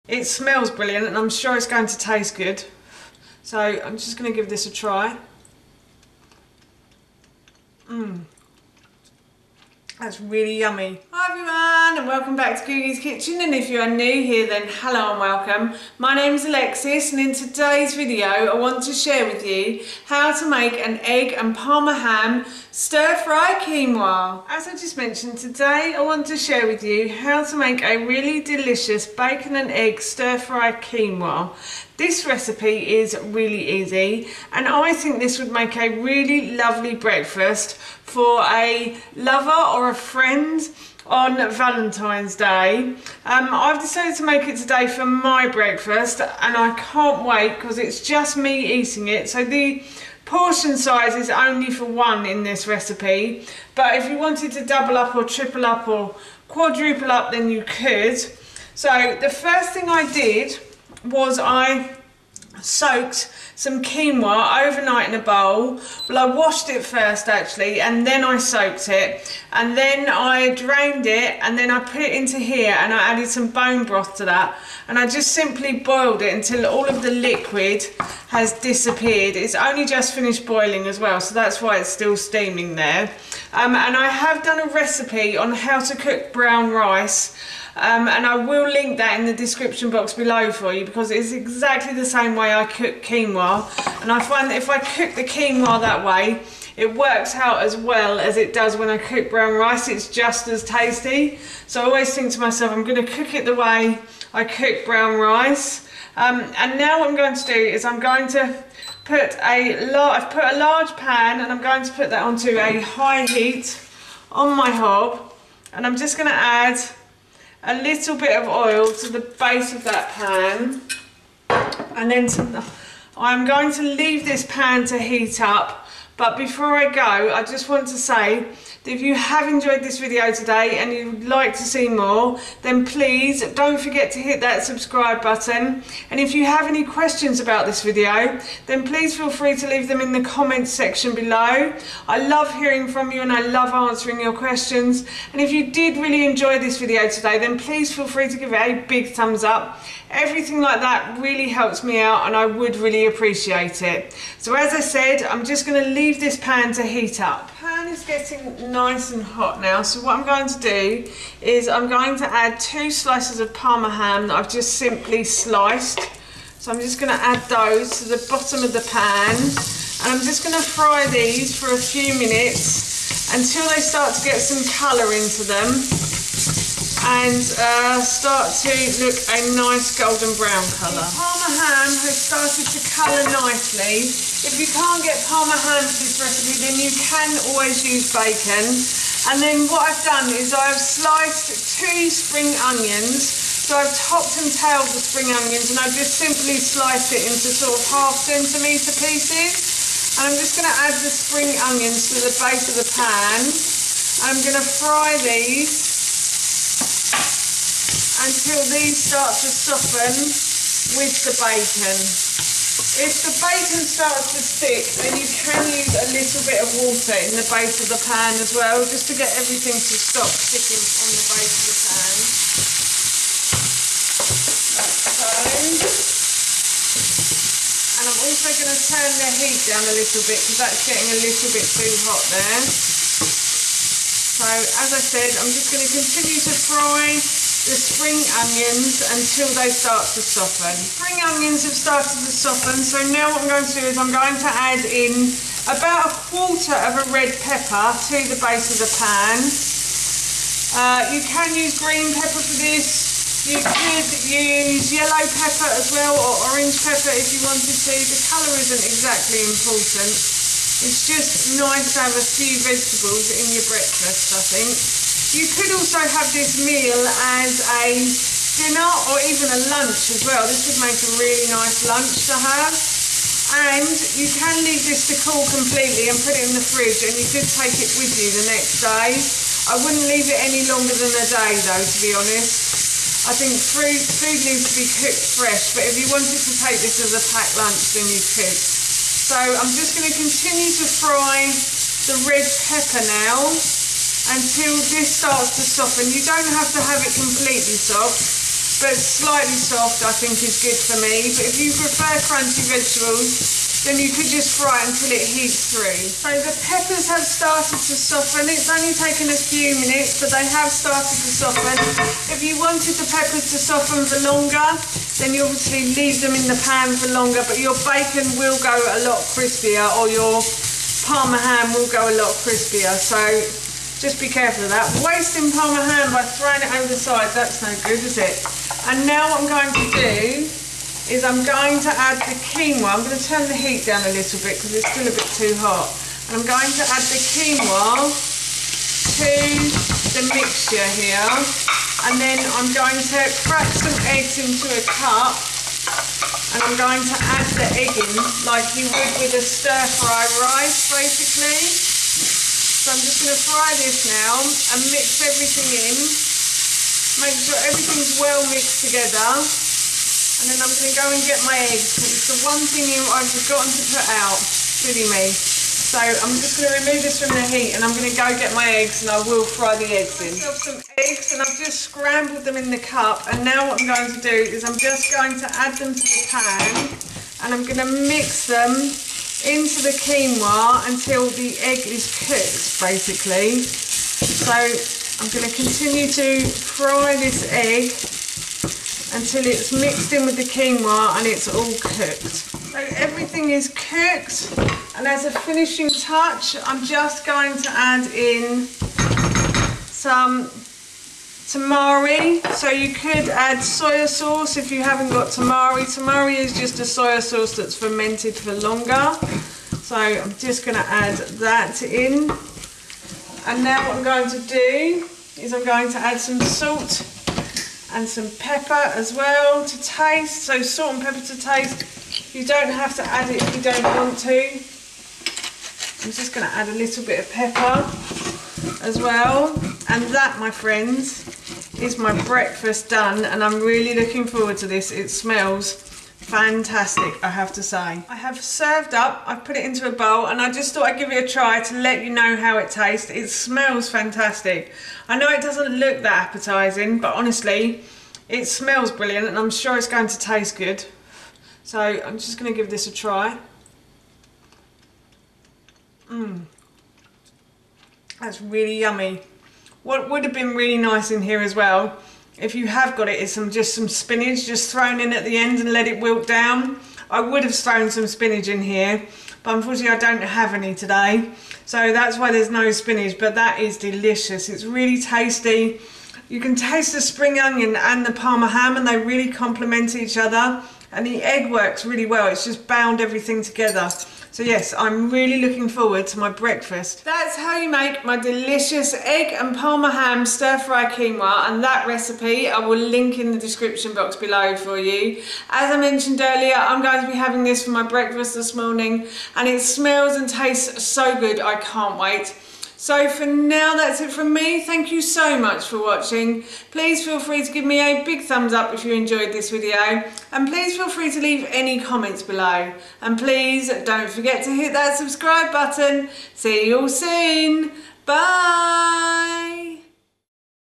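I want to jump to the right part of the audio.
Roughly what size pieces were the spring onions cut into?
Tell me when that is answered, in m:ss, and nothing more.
3:17.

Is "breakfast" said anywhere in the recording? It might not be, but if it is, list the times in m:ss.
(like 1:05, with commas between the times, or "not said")
0:36, 0:45, 4:23, 7:12, 8:06, 8:17.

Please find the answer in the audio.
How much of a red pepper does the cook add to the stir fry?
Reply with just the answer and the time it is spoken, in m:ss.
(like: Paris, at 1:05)
A quarter, at 4:05.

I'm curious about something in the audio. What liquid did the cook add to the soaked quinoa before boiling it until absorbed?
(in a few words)
Bone broth.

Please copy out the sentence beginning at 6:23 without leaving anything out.
So I'm going to continue to fry this egg until it's mixed in with the quinoa and it's all cooked.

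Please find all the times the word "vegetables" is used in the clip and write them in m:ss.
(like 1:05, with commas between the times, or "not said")
4:22, 5:02.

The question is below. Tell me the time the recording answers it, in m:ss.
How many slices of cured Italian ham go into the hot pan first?
2:42.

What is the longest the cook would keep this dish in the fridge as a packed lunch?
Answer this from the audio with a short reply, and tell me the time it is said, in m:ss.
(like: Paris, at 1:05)
A day, at 4:40.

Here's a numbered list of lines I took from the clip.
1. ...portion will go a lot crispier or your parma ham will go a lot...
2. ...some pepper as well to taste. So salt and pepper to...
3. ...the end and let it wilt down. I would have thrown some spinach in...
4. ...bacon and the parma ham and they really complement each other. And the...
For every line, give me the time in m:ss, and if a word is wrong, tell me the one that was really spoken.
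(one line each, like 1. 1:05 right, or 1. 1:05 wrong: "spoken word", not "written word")
1. 5:17 wrong: "bacon", not "portion"
2. 6:58 right
3. 7:45 right
4. 7:57 wrong: "onion", not "bacon".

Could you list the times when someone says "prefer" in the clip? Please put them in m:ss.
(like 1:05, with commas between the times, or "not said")
5:01.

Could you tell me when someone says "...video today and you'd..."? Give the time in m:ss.
2:09.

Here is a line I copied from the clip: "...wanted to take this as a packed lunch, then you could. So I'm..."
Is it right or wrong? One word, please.
right.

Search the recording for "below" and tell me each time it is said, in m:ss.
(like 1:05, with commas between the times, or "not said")
1:30, 2:21, 8:14, 8:32.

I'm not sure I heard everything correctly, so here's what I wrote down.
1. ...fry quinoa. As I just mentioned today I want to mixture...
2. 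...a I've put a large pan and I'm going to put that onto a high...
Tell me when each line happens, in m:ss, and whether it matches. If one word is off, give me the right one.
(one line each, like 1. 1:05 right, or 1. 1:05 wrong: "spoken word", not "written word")
1. 0:23 wrong: "share", not "mixture"
2. 1:49 right.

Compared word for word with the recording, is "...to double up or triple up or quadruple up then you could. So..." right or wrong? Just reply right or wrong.
right.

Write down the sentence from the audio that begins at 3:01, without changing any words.
Parma ham has started to colour nicely.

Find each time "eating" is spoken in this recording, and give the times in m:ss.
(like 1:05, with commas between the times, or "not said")
0:48.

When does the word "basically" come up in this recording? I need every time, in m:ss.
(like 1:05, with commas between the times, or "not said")
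5:50, 6:22.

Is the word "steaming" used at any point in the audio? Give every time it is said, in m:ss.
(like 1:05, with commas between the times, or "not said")
1:22.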